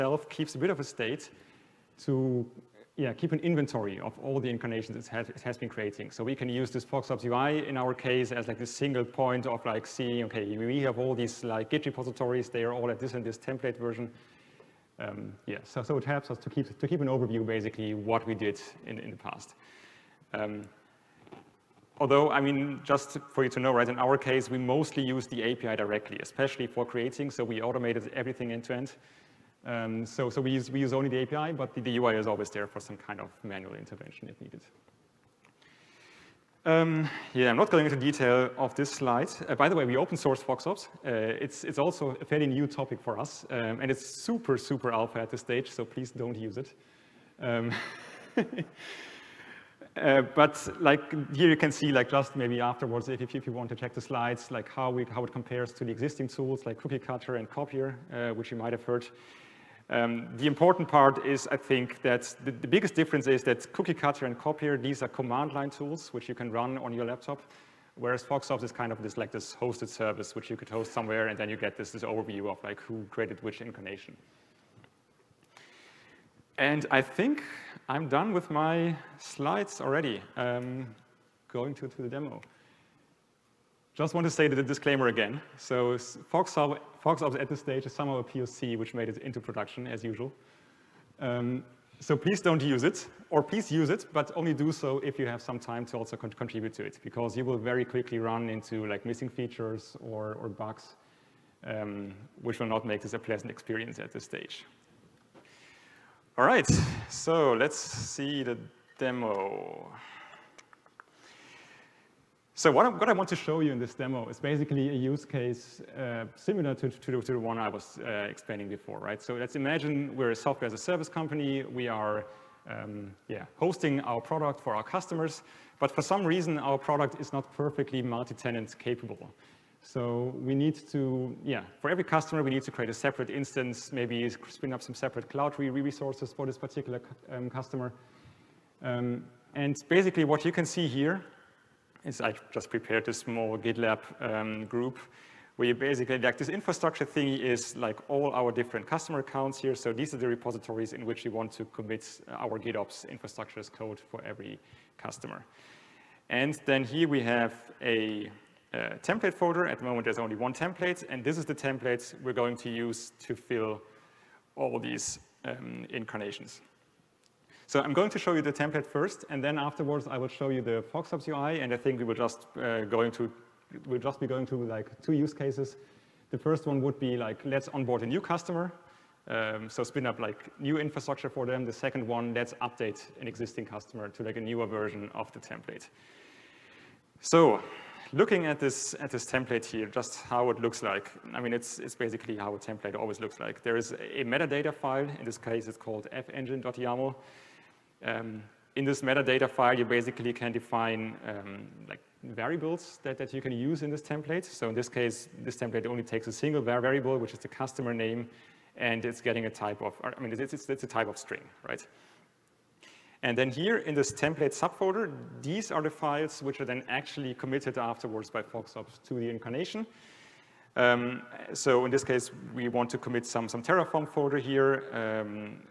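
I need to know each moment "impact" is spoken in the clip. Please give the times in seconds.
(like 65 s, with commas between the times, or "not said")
not said.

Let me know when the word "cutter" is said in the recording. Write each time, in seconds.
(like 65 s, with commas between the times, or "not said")
57 s, 63 s.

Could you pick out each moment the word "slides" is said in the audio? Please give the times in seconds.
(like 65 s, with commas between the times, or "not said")
38 s, 54 s, 79 s.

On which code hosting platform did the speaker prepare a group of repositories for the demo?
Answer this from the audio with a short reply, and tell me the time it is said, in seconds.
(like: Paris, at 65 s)
GitLab, at 143 s.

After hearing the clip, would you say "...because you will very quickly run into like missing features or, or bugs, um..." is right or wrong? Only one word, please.
right.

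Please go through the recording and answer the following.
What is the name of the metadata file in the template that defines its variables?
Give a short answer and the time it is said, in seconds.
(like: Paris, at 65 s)
fengine.yaml, at 196 s.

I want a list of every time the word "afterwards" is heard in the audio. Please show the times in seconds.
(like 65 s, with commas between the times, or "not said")
52 s, 169 s, 217 s.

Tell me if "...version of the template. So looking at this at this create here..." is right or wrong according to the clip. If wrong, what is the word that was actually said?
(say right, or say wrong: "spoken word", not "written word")
wrong: "template", not "create".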